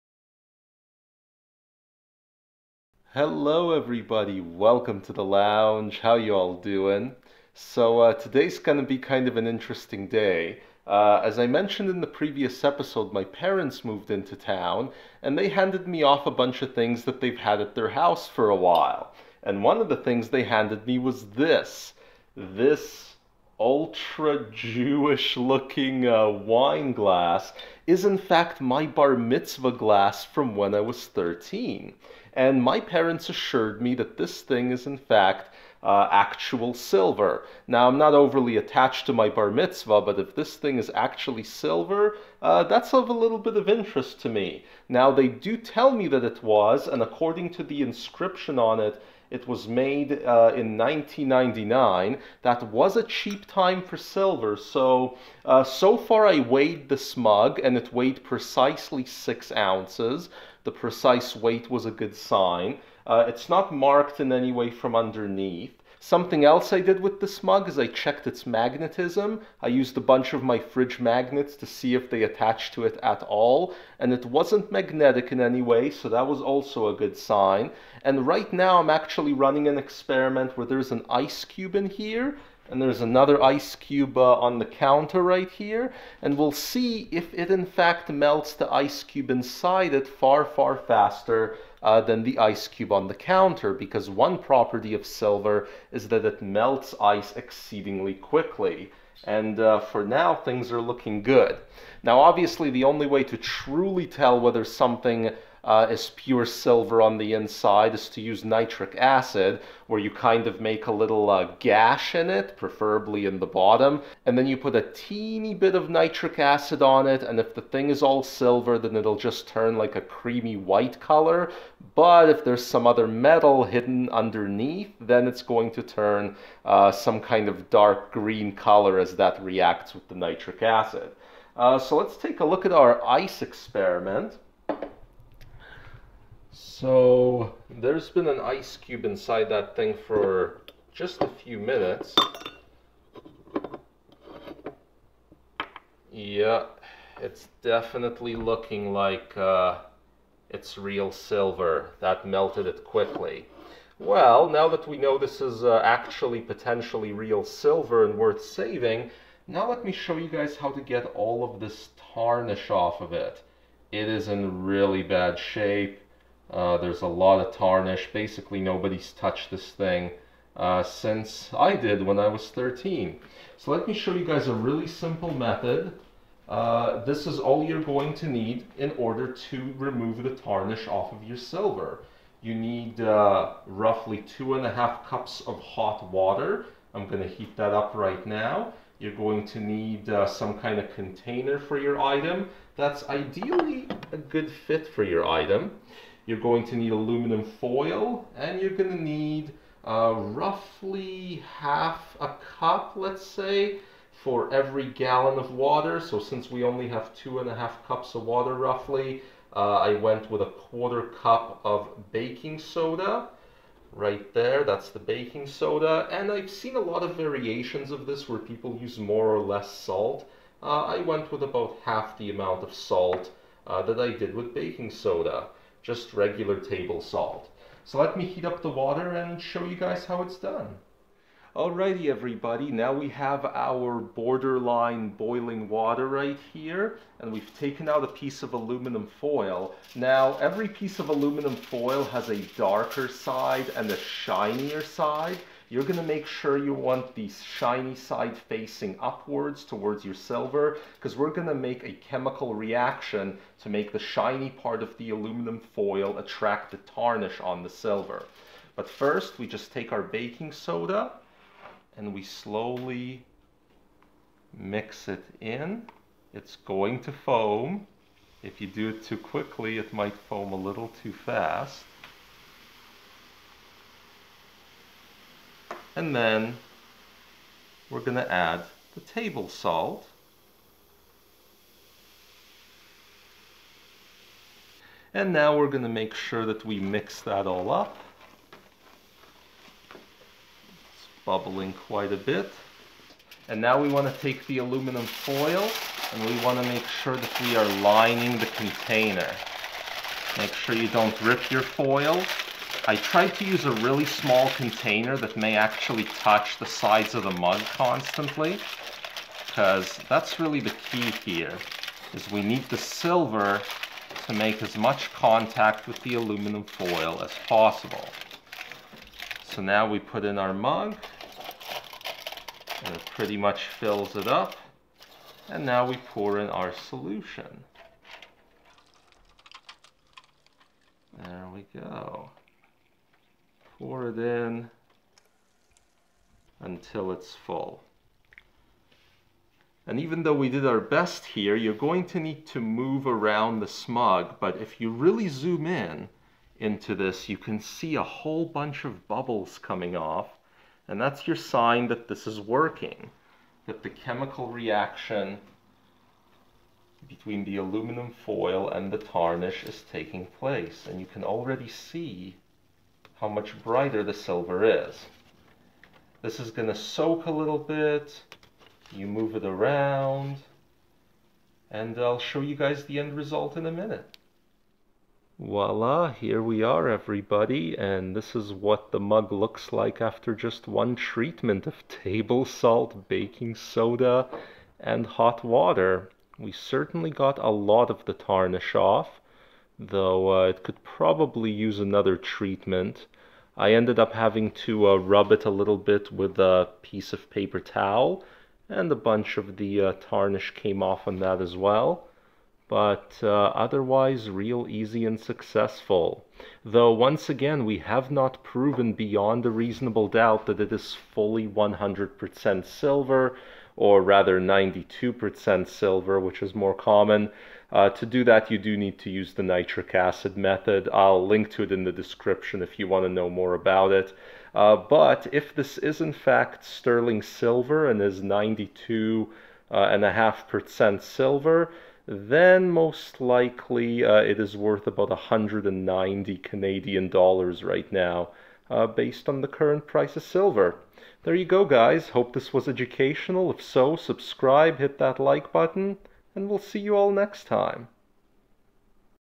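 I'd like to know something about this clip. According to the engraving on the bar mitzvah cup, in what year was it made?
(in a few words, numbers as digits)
1999.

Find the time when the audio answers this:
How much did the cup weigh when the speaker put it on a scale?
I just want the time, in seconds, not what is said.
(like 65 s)
59 s.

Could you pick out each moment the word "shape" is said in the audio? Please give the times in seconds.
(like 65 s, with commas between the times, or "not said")
165 s.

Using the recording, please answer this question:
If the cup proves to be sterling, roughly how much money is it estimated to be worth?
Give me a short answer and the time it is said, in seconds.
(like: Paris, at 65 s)
190 Canadian dollars, at 435 s.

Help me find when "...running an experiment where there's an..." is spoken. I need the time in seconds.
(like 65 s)
79 s.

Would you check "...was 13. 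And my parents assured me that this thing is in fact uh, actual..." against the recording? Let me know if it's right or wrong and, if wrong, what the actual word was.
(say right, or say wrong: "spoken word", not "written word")
right.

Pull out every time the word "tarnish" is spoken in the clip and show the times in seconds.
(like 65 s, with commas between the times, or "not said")
162 s, 167 s, 180 s, 256 s, 358 s, 388 s, 399 s.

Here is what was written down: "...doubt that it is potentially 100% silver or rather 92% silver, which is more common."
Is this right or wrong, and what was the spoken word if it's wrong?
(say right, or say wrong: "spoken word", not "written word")
wrong: "fully", not "potentially".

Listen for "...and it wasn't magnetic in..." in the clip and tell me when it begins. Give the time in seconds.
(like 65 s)
73 s.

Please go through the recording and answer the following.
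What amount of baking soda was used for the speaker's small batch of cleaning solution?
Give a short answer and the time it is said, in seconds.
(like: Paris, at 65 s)
A quarter cup, at 210 s.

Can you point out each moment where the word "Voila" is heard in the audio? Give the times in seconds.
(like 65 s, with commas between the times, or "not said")
375 s.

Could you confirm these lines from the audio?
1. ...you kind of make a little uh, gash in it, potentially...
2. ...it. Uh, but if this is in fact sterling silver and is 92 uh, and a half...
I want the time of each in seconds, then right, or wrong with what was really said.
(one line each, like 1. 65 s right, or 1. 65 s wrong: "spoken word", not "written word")
1. 109 s wrong: "preferably", not "potentially"
2. 423 s right.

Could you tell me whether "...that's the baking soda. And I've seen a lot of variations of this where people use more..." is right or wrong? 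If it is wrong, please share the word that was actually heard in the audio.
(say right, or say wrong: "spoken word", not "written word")
right.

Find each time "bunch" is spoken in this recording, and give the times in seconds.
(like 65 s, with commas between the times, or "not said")
16 s, 70 s, 348 s, 398 s.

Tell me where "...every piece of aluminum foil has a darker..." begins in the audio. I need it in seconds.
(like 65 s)
240 s.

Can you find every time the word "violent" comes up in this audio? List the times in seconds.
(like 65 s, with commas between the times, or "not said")
not said.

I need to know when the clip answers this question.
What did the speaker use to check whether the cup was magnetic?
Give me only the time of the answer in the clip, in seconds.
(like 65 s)
70 s.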